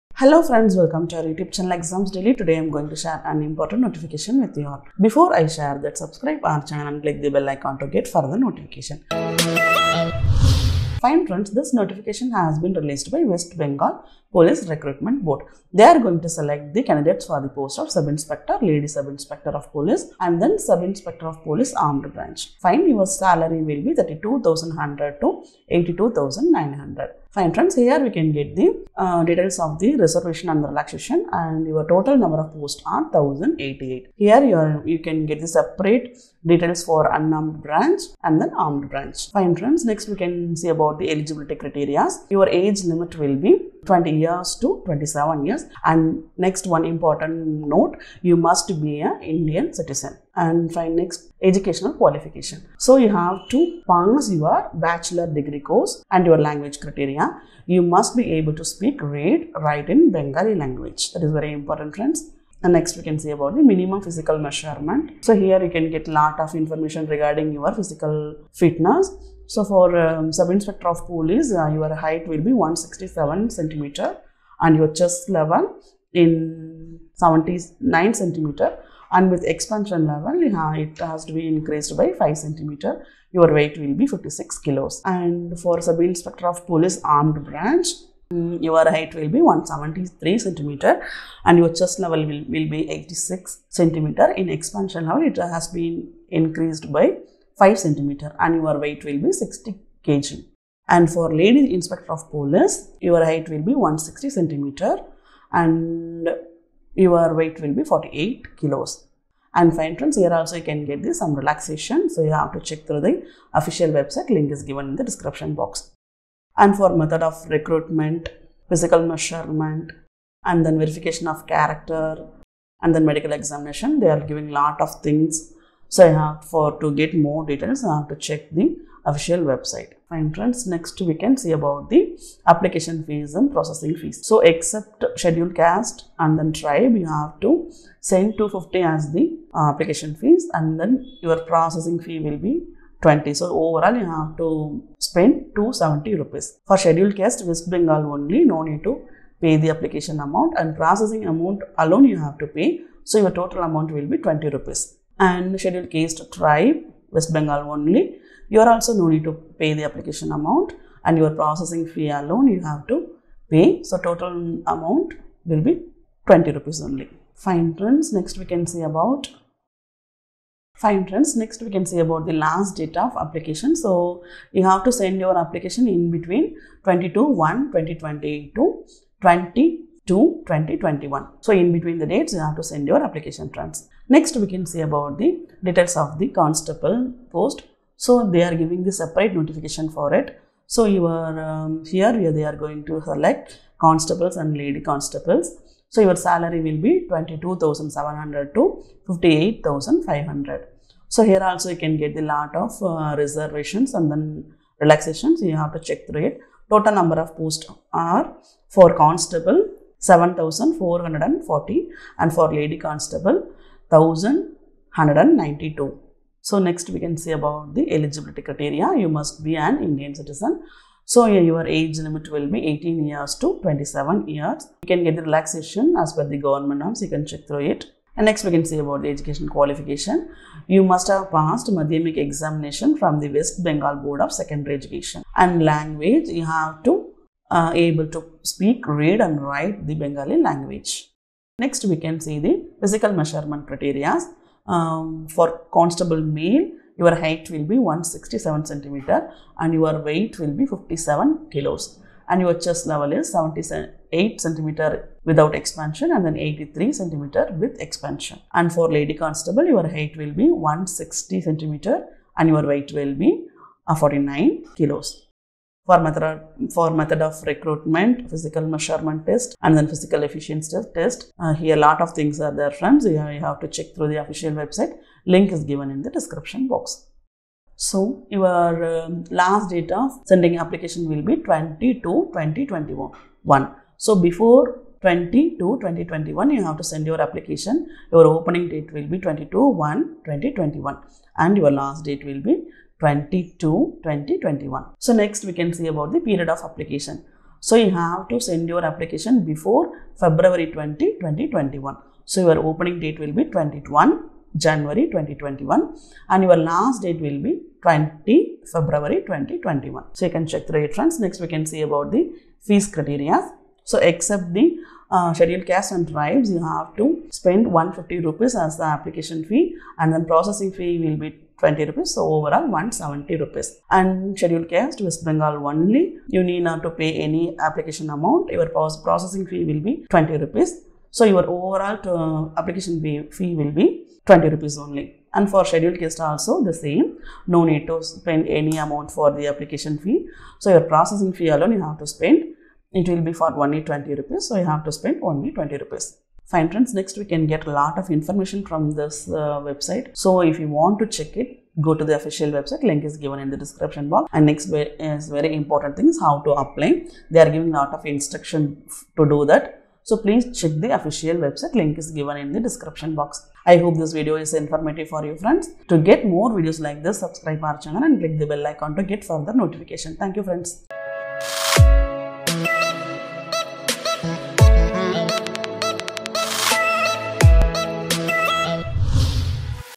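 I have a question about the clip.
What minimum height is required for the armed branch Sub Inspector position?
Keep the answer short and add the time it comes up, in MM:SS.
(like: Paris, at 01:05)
173 cm, at 01:29.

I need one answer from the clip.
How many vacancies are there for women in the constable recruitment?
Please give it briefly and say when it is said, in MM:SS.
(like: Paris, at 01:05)
1192, at 03:33.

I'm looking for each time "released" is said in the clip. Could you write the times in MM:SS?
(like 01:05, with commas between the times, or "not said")
00:12.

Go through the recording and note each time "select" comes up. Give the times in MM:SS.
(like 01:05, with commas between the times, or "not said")
00:16, 03:13.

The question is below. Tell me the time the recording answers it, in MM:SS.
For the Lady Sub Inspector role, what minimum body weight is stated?
01:47.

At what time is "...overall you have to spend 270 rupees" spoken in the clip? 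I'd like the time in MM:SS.
02:23.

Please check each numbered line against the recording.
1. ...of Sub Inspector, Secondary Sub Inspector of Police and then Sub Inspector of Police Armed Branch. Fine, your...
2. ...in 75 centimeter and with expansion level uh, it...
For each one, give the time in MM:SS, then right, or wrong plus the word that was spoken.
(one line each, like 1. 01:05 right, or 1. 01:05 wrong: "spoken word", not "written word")
1. 00:17 wrong: "Lady", not "Secondary"
2. 01:16 wrong: "79", not "75".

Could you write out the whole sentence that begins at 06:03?
I hope this video is informative for you friends.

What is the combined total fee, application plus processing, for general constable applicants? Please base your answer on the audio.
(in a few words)
170 rupees.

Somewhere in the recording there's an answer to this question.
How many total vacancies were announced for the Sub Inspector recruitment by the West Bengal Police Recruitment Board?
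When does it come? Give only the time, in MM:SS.
00:33.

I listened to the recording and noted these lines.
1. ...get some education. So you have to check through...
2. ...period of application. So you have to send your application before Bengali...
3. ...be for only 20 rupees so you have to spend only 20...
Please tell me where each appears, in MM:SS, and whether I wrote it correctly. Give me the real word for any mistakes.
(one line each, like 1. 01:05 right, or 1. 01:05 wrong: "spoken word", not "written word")
1. 01:50 wrong: "relaxation", not "education"
2. 04:56 wrong: "February", not "Bengali"
3. 05:43 right.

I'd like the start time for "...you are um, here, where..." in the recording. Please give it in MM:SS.
03:10.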